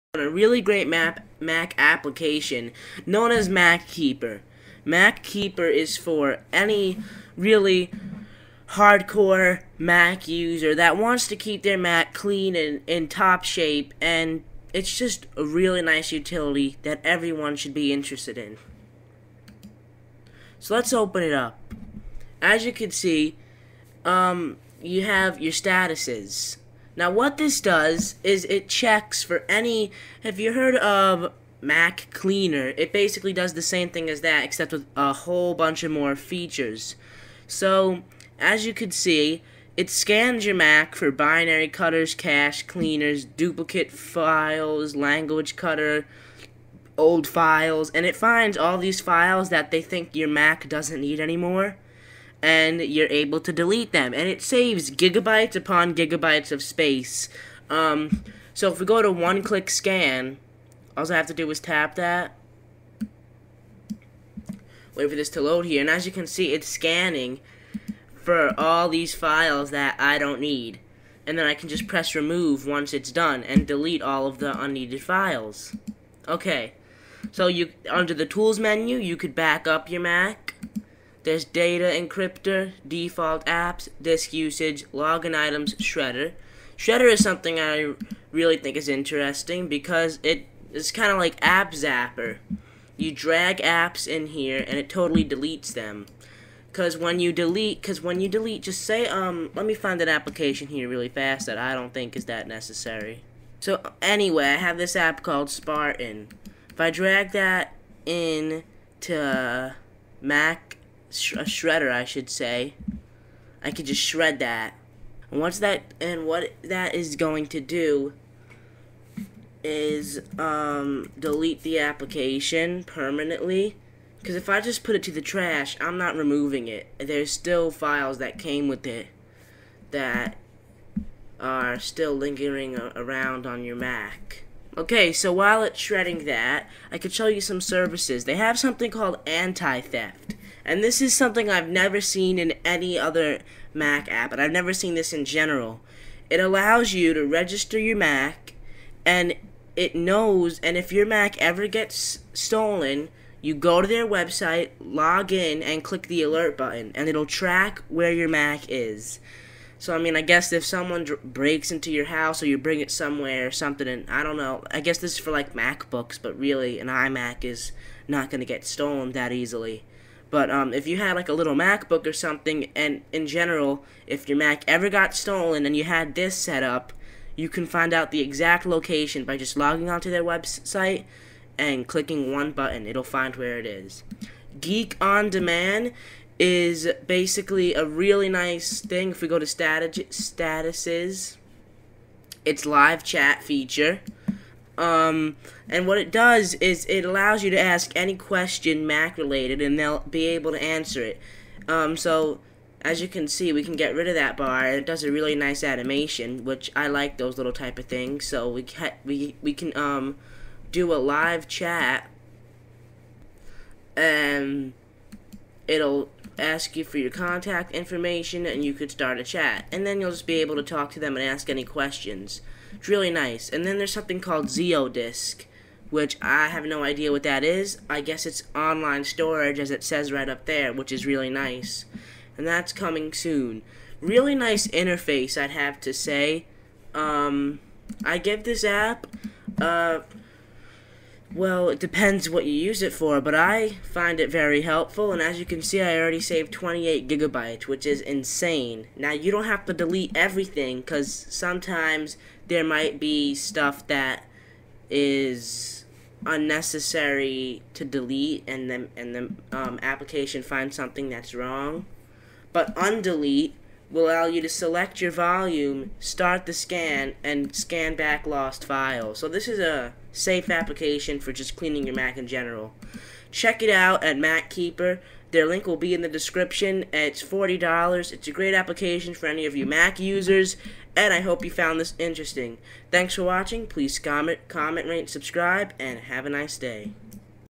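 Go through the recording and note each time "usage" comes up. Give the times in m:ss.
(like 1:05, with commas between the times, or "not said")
1:24.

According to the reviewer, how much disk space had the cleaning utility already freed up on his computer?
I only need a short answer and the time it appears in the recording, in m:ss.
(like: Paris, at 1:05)
28 gigabytes, at 4:06.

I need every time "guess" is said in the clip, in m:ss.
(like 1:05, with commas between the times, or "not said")
2:40, 2:44, 3:48.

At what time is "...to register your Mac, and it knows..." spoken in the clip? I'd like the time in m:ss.
2:27.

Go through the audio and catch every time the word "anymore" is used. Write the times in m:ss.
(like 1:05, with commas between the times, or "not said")
0:51.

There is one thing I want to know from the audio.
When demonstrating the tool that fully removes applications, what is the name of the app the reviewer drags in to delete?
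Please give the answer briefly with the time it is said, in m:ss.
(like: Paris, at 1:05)
Spartan, at 1:45.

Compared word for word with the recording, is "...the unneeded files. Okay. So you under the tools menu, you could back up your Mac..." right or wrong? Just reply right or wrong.
right.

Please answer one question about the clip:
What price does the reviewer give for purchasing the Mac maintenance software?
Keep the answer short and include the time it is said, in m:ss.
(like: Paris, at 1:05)
$40, at 4:37.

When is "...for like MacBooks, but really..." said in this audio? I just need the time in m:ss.
2:45.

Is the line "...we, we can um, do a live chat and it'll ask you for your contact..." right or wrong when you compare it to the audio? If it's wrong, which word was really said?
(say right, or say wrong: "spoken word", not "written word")
right.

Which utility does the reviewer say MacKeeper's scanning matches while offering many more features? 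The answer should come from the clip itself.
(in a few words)
Mac Cleaner.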